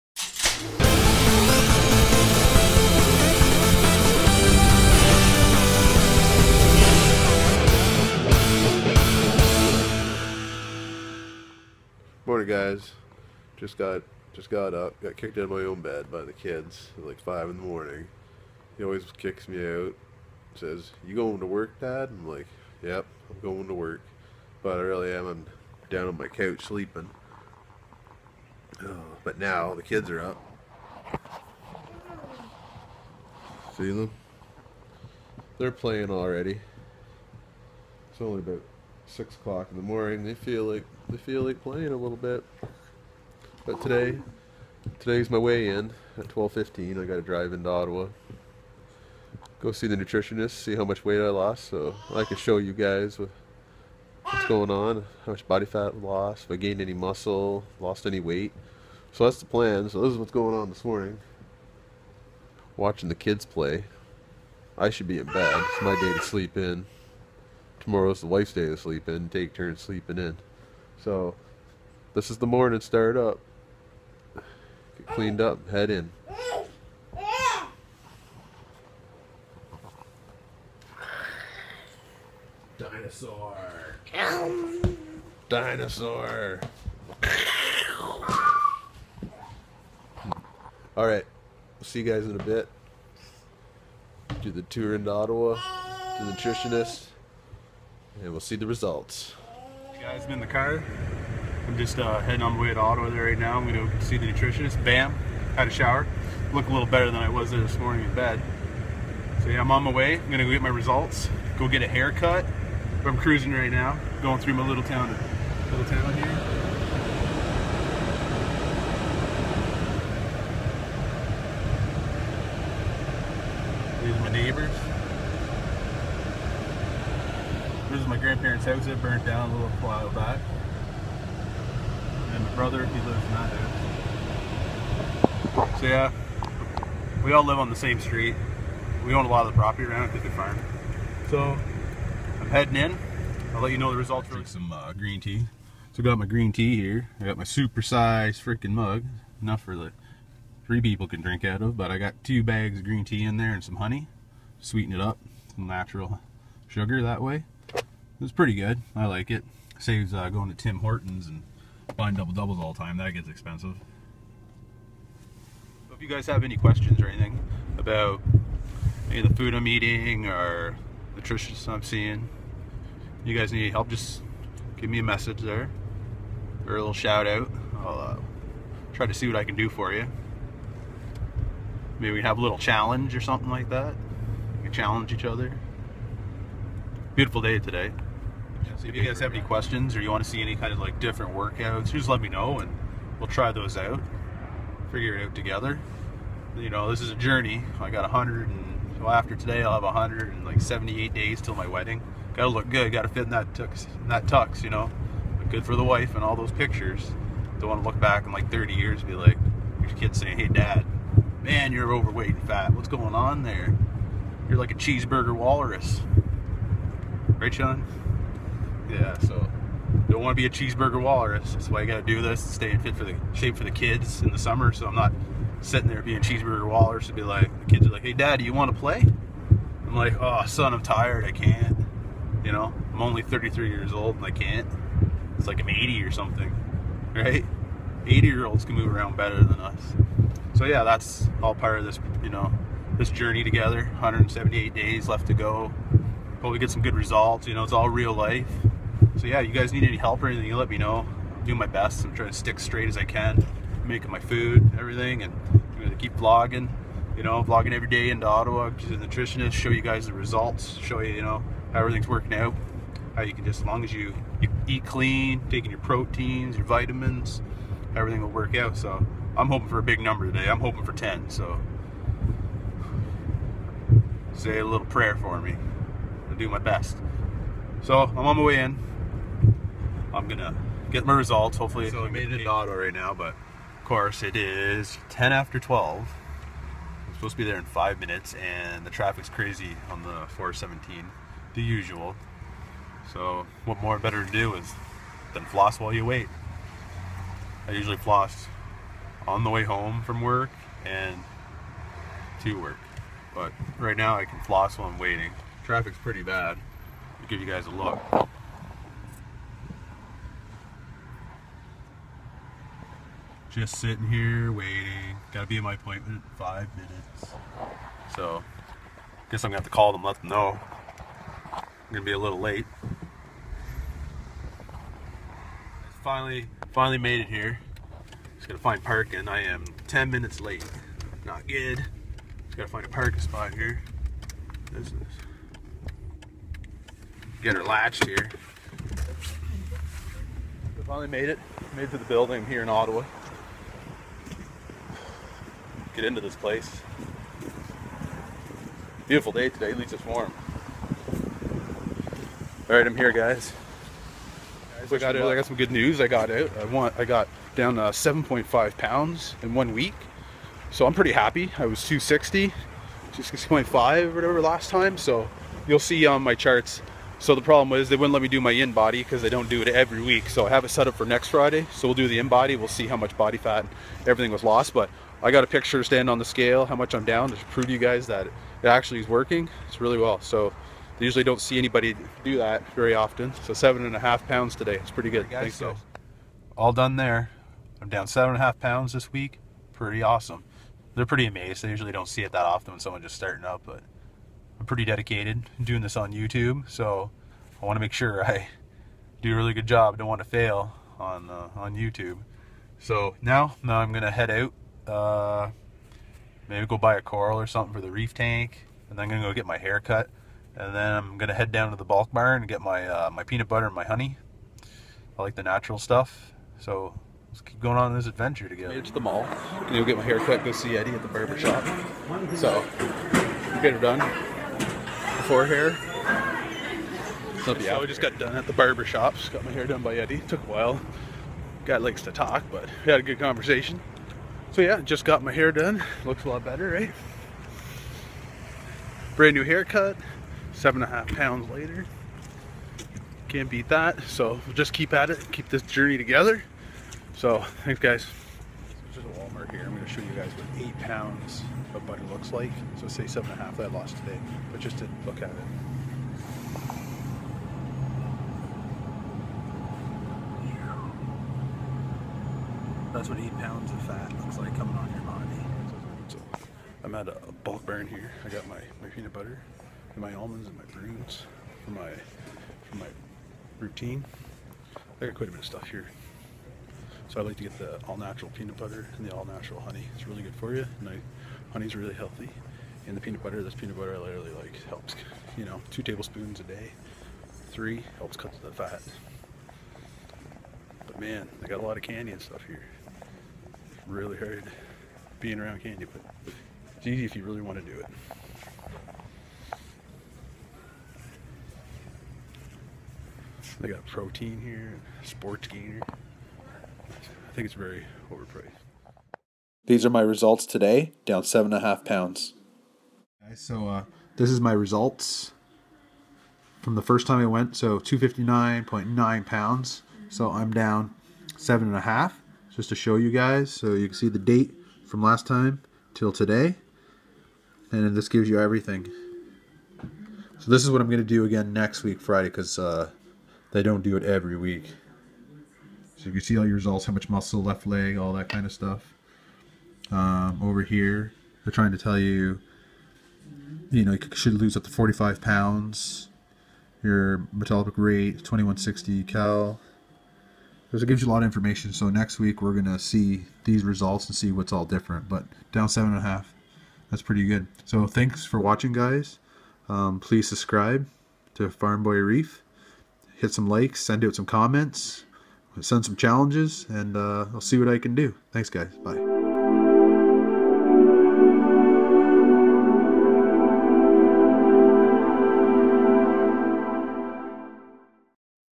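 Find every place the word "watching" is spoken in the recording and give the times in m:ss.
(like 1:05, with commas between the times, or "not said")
1:02, 9:18.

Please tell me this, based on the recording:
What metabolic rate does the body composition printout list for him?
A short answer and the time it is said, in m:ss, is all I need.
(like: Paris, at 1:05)
2160 calories, at 9:08.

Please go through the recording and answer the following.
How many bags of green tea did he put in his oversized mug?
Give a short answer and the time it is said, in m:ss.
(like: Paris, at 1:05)
2, at 2:32.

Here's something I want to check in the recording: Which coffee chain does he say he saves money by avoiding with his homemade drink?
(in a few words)
Tim Hortons.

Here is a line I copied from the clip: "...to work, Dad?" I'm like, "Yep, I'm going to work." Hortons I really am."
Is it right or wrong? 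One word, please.
wrong.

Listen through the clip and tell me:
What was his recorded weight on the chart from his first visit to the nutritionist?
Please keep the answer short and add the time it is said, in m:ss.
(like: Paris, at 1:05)
259.9 pounds, at 8:37.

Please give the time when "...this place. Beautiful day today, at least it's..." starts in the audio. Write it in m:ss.
5:46.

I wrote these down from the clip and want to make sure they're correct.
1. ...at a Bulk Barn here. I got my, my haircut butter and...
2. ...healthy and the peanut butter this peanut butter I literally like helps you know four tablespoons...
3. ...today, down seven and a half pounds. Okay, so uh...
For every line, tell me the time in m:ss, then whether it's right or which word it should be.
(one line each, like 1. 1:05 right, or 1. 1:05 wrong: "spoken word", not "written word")
1. 7:46 wrong: "peanut", not "haircut"
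2. 8:01 wrong: "two", not "four"
3. 8:30 right.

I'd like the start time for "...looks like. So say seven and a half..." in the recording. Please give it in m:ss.
7:32.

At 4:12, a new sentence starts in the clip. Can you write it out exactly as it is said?
I'm trying to stick straight as I can.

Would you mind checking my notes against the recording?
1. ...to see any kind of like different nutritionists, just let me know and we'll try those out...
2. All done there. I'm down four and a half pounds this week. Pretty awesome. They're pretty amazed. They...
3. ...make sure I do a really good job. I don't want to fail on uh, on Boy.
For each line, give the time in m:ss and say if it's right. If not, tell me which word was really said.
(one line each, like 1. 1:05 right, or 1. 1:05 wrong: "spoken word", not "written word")
1. 3:10 wrong: "workouts", not "nutritionists"
2. 6:26 wrong: "seven", not "four"
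3. 6:37 wrong: "YouTube", not "Boy".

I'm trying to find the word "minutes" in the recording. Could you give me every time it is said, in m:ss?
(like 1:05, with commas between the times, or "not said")
4:47, 5:16, 5:30.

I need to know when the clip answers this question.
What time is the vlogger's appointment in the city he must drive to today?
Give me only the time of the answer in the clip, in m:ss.
0:46.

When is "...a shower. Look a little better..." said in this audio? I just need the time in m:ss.
1:45.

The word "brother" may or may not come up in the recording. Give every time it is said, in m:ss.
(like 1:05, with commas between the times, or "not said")
2:12.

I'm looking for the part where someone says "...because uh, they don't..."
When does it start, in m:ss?
8:52.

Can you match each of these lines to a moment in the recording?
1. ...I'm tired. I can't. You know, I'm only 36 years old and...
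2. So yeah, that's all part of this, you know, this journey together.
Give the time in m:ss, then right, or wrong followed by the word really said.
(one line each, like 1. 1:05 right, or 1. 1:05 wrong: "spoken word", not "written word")
1. 3:50 wrong: "33", not "36"
2. 4:00 right.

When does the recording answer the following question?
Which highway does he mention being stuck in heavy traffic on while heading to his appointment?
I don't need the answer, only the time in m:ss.
4:50.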